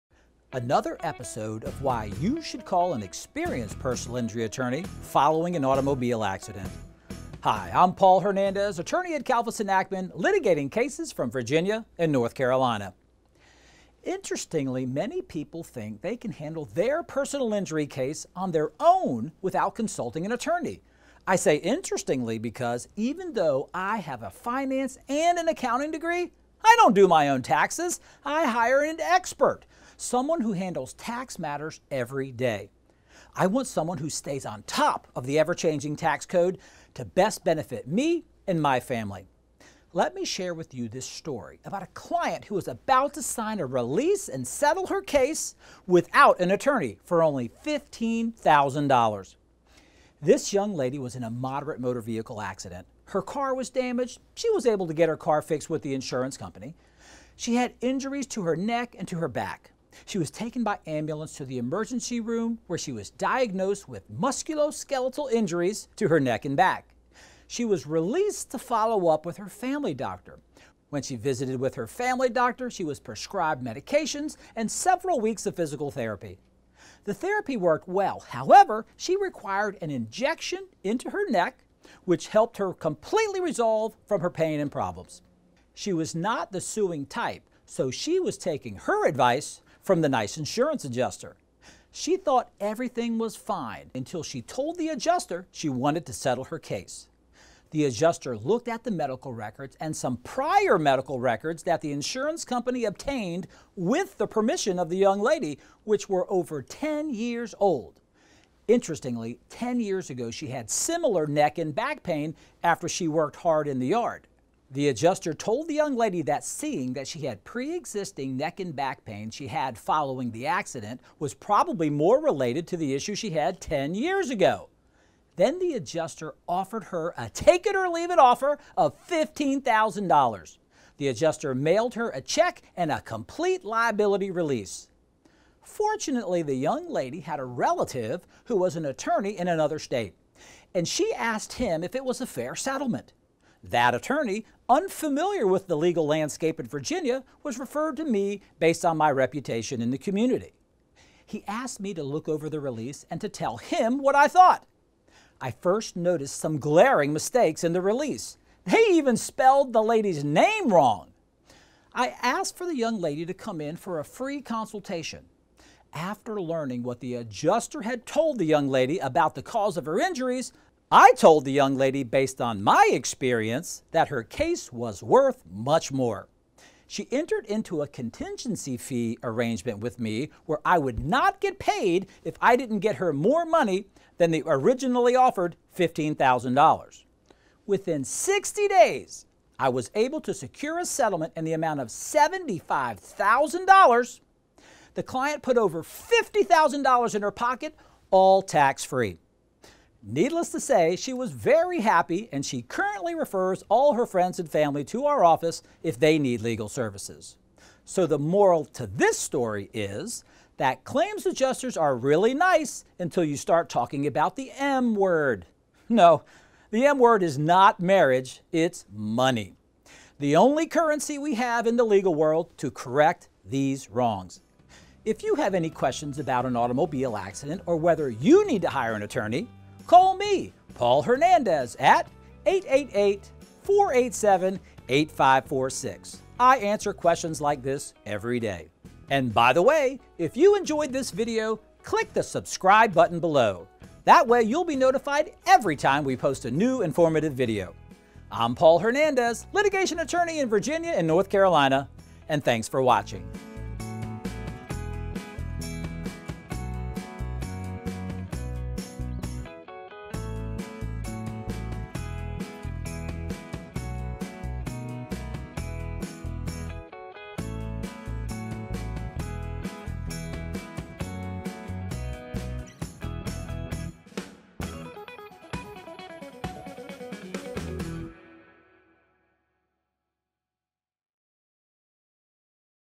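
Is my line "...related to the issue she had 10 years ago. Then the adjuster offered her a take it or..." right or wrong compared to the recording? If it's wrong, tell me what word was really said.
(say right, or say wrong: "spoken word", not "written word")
right.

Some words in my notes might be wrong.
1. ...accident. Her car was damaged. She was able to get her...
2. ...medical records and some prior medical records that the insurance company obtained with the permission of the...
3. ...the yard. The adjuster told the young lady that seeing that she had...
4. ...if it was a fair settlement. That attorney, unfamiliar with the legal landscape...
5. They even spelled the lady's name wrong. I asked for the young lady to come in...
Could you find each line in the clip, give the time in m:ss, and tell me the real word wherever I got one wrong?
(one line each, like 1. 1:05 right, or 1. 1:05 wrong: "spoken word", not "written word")
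1. 0:52 right
2. 1:38 right
3. 1:53 right
4. 2:21 right
5. 2:38 right.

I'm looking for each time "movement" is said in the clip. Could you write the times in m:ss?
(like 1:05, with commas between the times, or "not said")
not said.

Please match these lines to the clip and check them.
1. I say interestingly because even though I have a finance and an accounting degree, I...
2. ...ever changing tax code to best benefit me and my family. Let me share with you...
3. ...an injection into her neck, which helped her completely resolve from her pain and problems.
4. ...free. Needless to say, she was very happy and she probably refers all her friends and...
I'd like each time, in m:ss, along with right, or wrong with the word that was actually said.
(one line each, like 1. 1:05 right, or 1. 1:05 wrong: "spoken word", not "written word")
1. 0:21 right
2. 0:35 right
3. 1:19 right
4. 3:18 wrong: "currently", not "probably".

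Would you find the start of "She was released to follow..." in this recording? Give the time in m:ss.
1:07.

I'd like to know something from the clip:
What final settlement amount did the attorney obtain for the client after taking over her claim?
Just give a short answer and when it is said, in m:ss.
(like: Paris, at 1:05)
$75,000, at 3:11.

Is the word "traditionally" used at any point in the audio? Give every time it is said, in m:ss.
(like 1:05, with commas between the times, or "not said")
not said.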